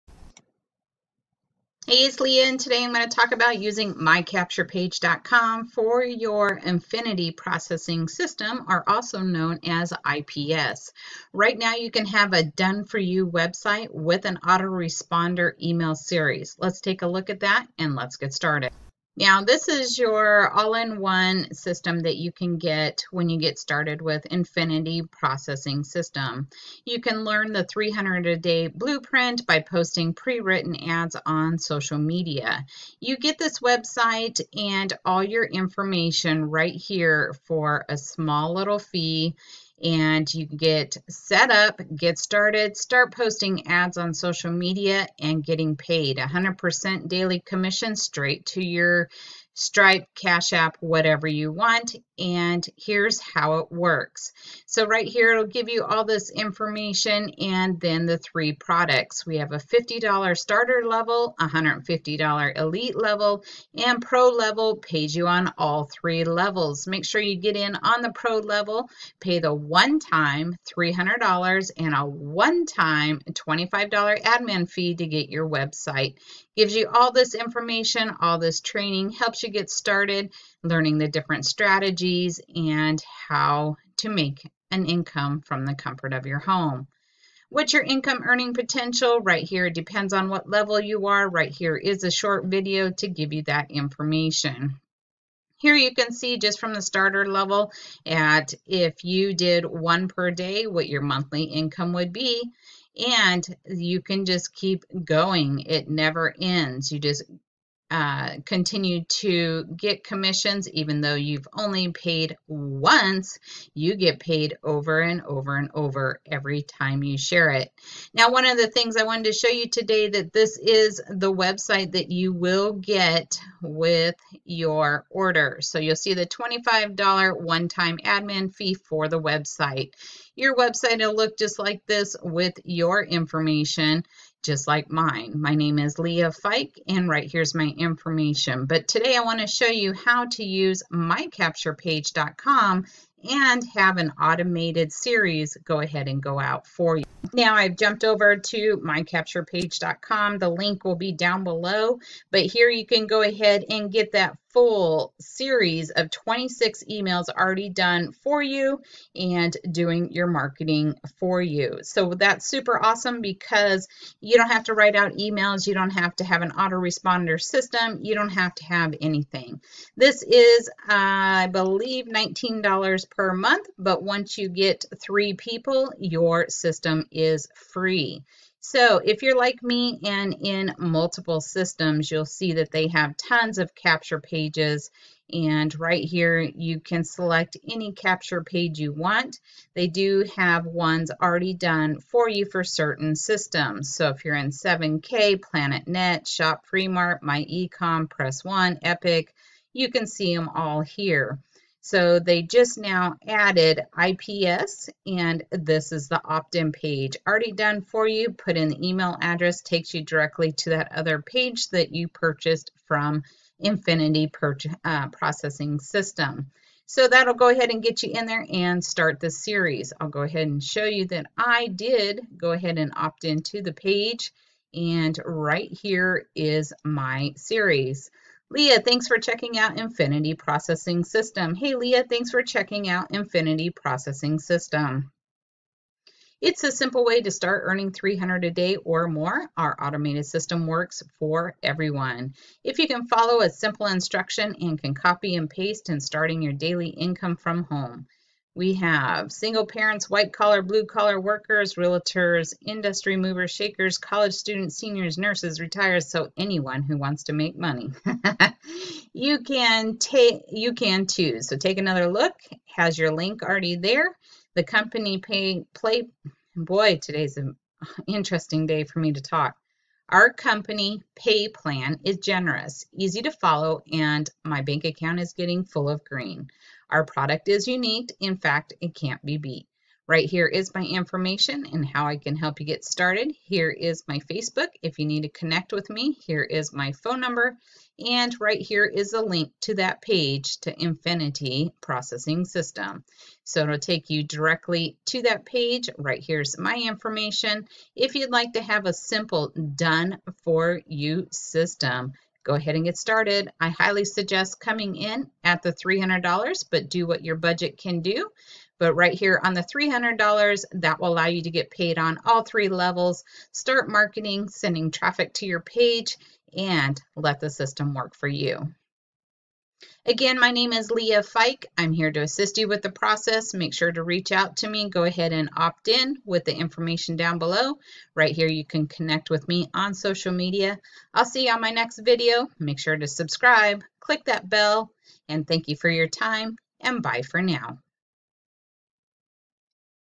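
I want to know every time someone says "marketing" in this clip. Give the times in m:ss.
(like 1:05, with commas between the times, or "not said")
2:40, 5:13.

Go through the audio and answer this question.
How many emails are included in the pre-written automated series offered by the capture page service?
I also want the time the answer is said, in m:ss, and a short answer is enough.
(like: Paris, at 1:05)
26, at 2:36.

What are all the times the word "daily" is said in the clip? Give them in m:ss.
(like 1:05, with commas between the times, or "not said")
0:47, 4:06.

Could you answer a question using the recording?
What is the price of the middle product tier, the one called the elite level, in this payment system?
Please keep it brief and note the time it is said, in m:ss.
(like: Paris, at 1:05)
$150, at 1:01.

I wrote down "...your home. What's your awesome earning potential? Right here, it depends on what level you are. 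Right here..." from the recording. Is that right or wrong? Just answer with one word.
wrong.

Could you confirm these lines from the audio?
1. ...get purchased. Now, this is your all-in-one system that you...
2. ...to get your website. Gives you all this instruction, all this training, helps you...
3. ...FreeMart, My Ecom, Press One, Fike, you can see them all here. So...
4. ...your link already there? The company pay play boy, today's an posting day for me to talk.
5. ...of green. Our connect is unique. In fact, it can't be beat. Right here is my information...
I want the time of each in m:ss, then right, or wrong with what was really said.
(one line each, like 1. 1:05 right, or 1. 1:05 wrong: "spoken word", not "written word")
1. 0:18 wrong: "started", not "purchased"
2. 1:14 wrong: "information", not "instruction"
3. 3:16 wrong: "Epic", not "Fike"
4. 4:22 wrong: "interesting", not "posting"
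5. 4:35 wrong: "product", not "connect".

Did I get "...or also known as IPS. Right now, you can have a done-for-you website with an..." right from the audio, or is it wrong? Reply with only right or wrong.
right.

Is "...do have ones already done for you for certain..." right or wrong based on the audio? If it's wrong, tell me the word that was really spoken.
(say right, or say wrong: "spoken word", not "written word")
right.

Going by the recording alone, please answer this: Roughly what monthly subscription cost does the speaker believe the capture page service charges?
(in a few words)
$19 per month.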